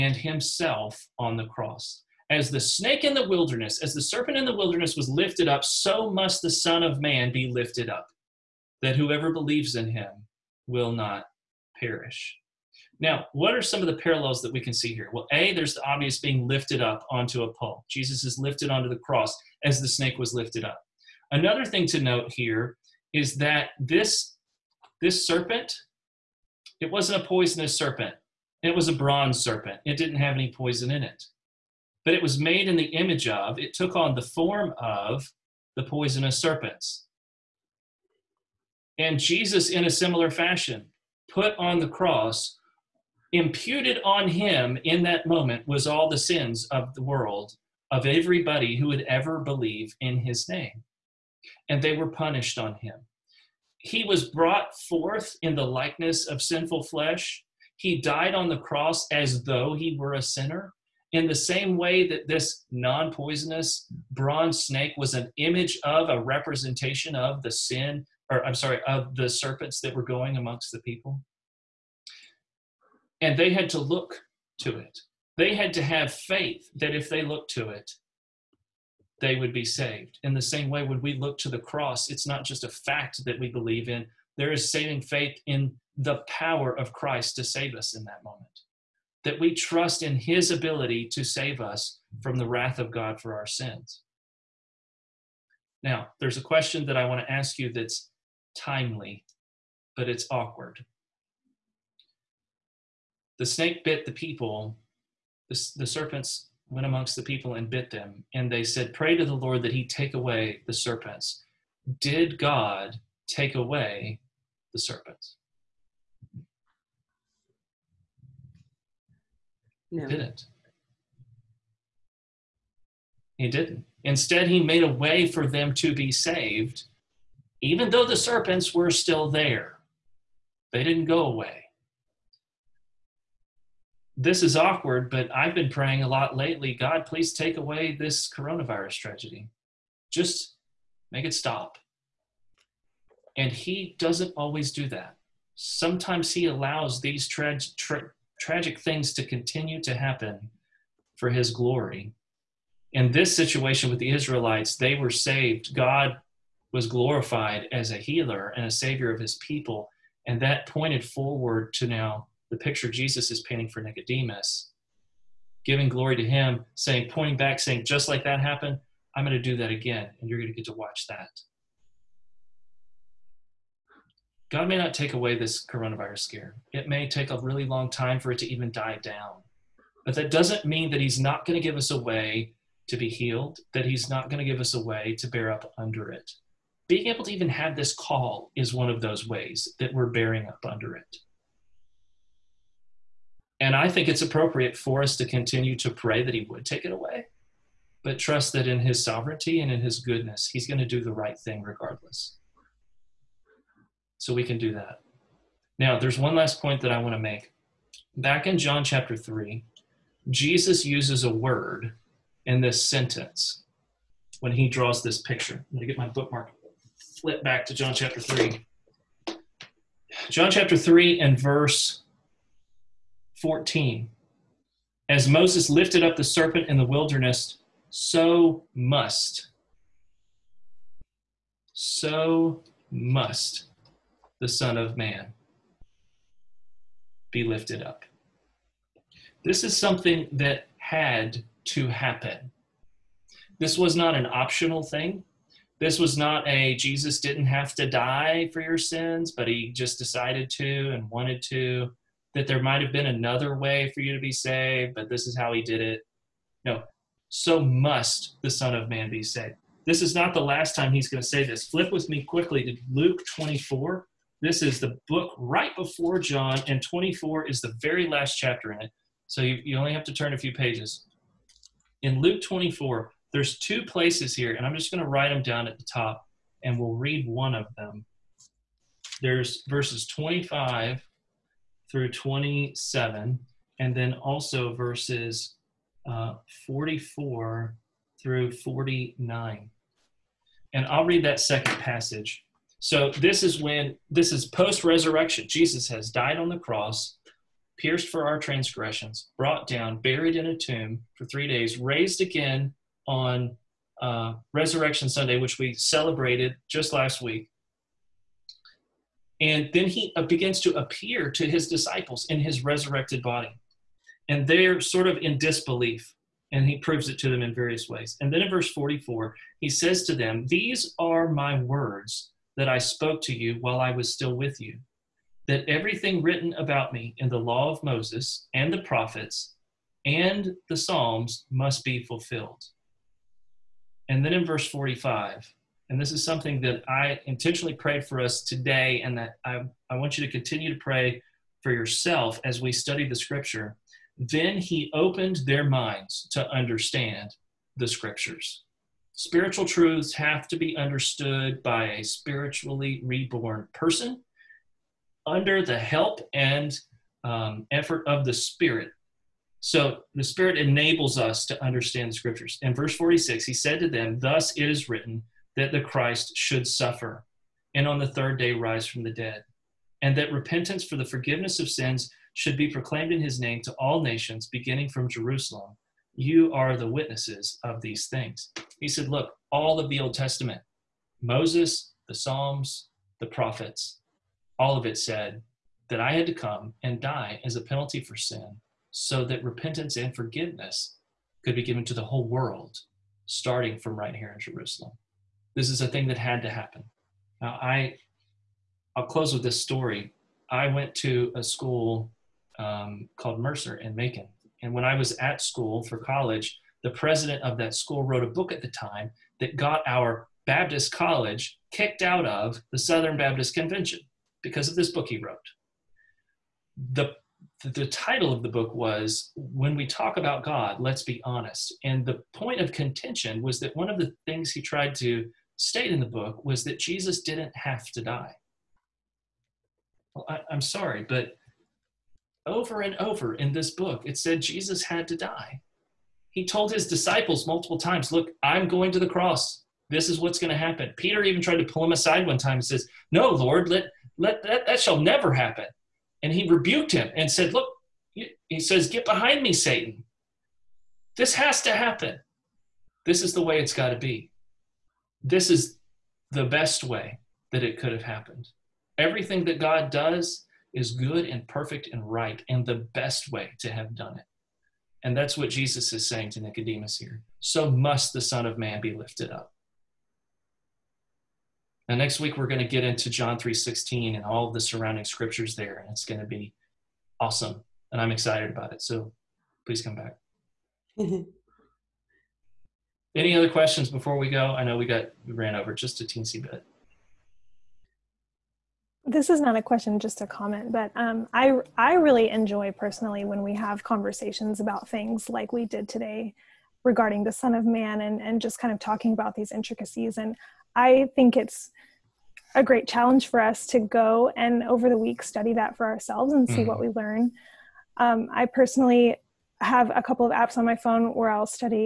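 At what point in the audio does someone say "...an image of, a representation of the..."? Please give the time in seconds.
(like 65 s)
65 s.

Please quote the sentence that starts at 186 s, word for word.
Being able to even have this call is one of those ways that we're bearing up under it.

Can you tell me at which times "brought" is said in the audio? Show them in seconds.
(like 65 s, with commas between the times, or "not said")
54 s, 299 s.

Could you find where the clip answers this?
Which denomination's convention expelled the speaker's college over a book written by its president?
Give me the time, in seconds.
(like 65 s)
412 s.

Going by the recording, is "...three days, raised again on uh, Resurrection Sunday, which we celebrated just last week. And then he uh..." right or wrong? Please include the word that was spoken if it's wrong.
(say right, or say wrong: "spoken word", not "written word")
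right.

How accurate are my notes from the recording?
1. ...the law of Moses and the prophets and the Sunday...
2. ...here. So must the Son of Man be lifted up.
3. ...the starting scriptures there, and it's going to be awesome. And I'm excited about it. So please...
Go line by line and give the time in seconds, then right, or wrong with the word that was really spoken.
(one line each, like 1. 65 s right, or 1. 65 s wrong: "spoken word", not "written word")
1. 327 s wrong: "Psalms", not "Sunday"
2. 466 s right
3. 474 s wrong: "surrounding", not "starting".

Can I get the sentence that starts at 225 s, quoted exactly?
As Moses lifted up the serpent in the wilderness, so must.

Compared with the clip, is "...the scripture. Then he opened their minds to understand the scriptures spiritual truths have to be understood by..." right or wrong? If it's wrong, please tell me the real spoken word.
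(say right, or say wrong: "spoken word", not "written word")
right.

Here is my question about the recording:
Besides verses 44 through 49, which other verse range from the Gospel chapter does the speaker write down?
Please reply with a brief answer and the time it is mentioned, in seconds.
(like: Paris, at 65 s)
25 through 27, at 280 s.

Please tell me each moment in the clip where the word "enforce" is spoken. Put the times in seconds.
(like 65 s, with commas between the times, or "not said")
not said.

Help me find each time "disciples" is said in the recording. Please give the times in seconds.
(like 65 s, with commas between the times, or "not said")
311 s, 436 s.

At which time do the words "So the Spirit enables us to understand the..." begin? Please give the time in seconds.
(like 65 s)
359 s.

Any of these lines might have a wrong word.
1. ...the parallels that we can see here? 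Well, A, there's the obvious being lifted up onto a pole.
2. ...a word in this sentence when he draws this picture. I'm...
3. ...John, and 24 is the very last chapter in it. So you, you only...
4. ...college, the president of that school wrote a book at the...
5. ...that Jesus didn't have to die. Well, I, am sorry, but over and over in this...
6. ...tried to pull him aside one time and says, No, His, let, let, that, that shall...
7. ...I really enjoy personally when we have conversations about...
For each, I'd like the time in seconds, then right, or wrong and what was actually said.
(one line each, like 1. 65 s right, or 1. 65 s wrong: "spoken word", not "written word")
1. 13 s right
2. 211 s right
3. 266 s right
4. 405 s right
5. 426 s right
6. 441 s wrong: "Lord", not "His"
7. 491 s right.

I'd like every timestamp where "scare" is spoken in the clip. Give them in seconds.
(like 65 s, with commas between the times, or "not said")
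176 s.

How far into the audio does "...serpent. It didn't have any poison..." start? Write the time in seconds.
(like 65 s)
29 s.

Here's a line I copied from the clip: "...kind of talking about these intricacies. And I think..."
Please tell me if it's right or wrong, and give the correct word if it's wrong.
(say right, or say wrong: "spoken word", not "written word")
right.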